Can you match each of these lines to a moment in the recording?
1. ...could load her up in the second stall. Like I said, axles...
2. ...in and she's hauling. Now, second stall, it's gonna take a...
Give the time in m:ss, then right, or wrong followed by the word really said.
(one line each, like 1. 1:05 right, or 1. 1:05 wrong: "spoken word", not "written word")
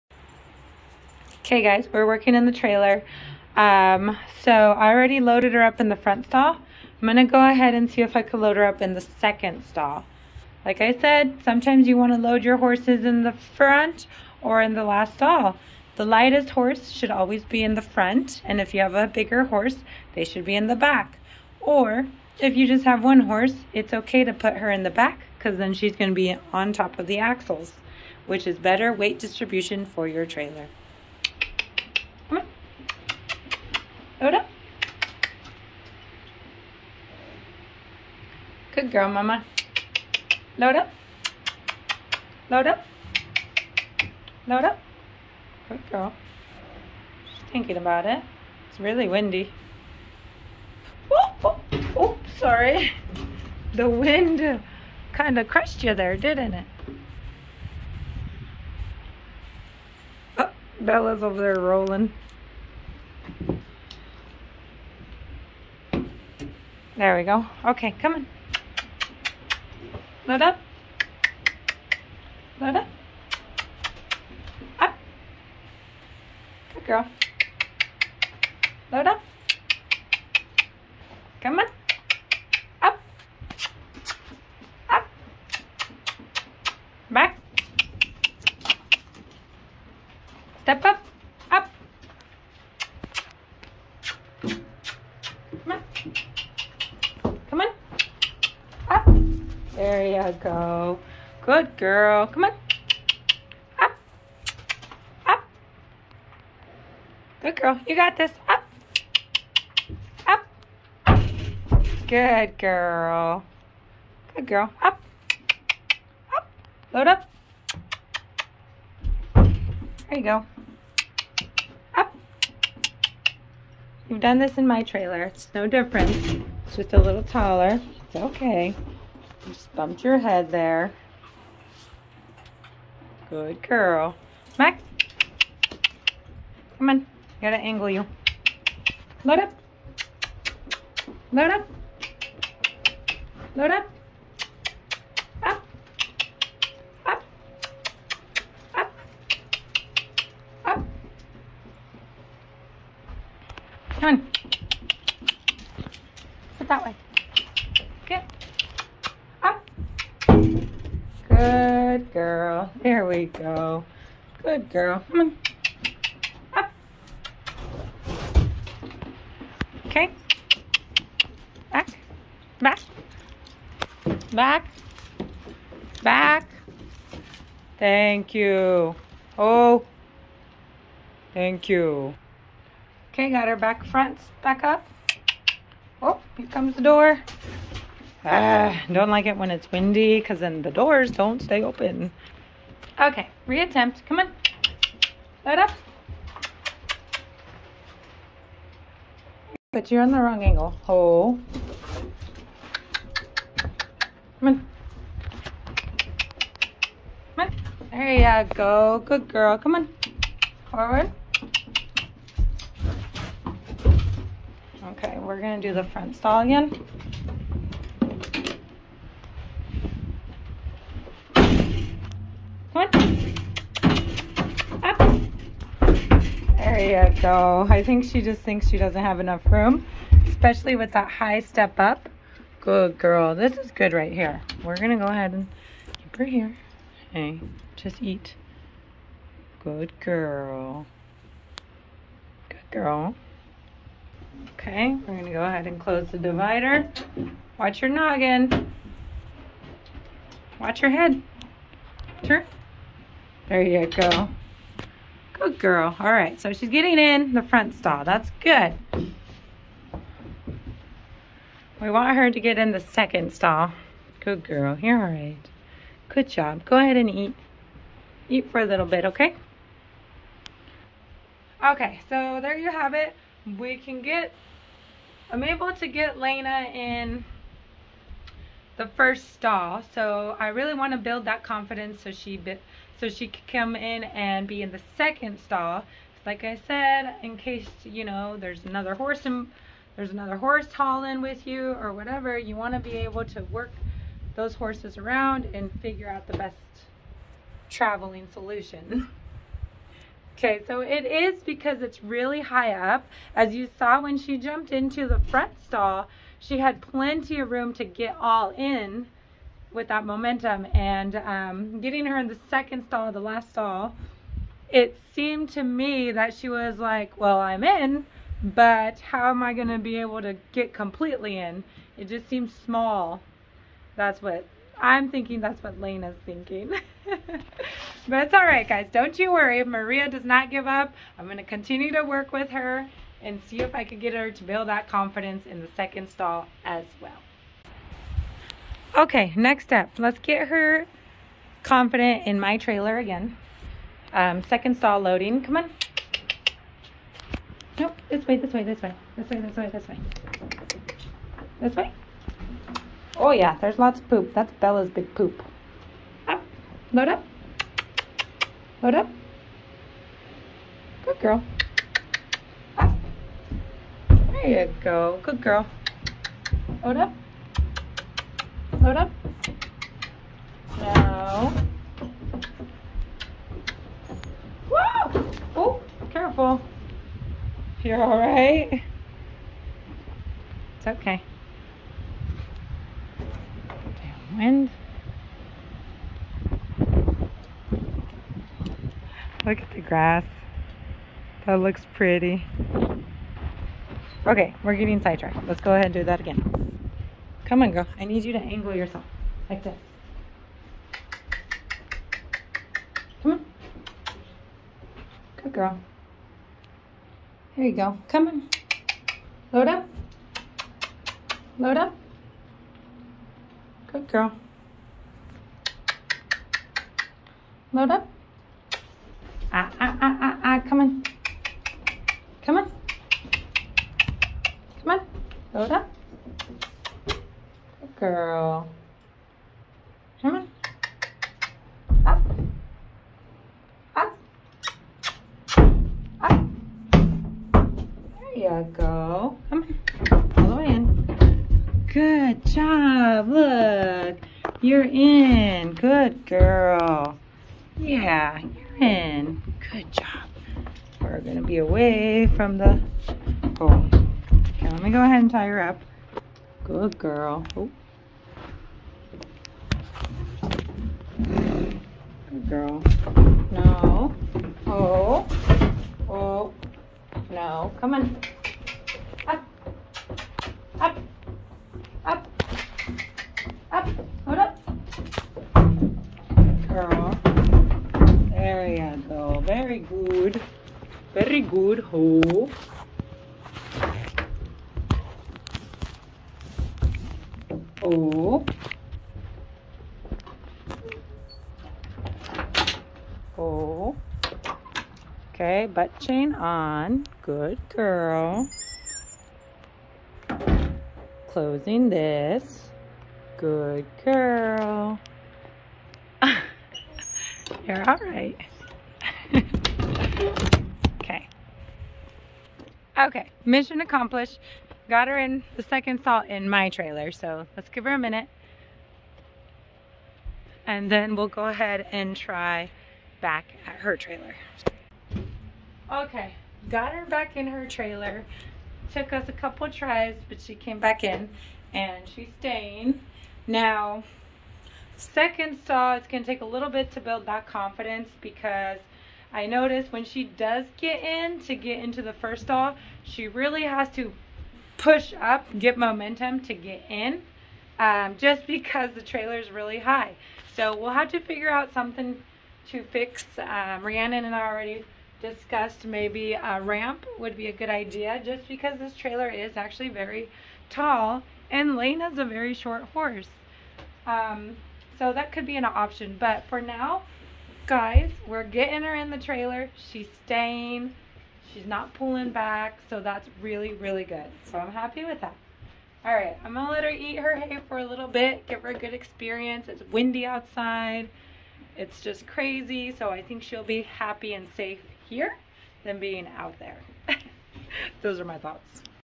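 1. 0:08 wrong: "sometimes", not "axles"
2. 8:51 wrong: "staying", not "hauling".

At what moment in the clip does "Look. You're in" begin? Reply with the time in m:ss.
7:23.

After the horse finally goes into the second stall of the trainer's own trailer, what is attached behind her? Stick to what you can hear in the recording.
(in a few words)
Butt chain.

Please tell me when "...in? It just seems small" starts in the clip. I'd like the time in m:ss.
5:21.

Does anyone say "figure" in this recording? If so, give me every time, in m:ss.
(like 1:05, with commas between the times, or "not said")
4:55, 9:11.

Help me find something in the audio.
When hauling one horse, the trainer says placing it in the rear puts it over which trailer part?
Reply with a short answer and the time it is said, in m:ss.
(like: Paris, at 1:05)
Axles, at 0:27.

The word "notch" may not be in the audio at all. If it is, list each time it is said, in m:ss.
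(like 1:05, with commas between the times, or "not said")
not said.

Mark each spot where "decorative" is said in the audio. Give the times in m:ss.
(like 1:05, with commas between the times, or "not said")
not said.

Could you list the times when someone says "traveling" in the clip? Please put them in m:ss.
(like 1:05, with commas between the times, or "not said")
4:57.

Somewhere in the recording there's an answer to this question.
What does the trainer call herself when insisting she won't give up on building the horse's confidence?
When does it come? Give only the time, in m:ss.
5:29.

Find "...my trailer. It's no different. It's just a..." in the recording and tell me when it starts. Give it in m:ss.
2:04.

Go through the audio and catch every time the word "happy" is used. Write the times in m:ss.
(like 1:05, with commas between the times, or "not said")
9:34, 9:43.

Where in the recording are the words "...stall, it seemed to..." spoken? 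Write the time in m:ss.
5:13.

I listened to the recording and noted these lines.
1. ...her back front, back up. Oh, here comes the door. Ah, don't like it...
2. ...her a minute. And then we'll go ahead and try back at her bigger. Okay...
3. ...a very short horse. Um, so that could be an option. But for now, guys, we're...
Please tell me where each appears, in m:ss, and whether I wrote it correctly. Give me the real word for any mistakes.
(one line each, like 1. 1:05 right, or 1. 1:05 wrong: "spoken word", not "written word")
1. 3:03 right
2. 8:37 wrong: "trailer", not "bigger"
3. 9:22 right.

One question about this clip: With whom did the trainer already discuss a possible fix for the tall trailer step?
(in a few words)
Rhiannon.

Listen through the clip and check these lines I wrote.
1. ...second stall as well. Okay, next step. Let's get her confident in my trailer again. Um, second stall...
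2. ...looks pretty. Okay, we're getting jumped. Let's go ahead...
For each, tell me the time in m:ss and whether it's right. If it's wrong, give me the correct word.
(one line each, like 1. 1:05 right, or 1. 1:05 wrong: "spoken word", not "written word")
1. 5:35 right
2. 6:31 wrong: "sidetracked", not "jumped".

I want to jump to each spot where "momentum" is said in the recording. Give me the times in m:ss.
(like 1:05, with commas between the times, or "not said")
5:10, 9:05.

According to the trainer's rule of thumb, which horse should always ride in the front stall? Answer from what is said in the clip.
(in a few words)
The lightest horse.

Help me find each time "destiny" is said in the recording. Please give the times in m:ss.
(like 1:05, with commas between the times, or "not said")
not said.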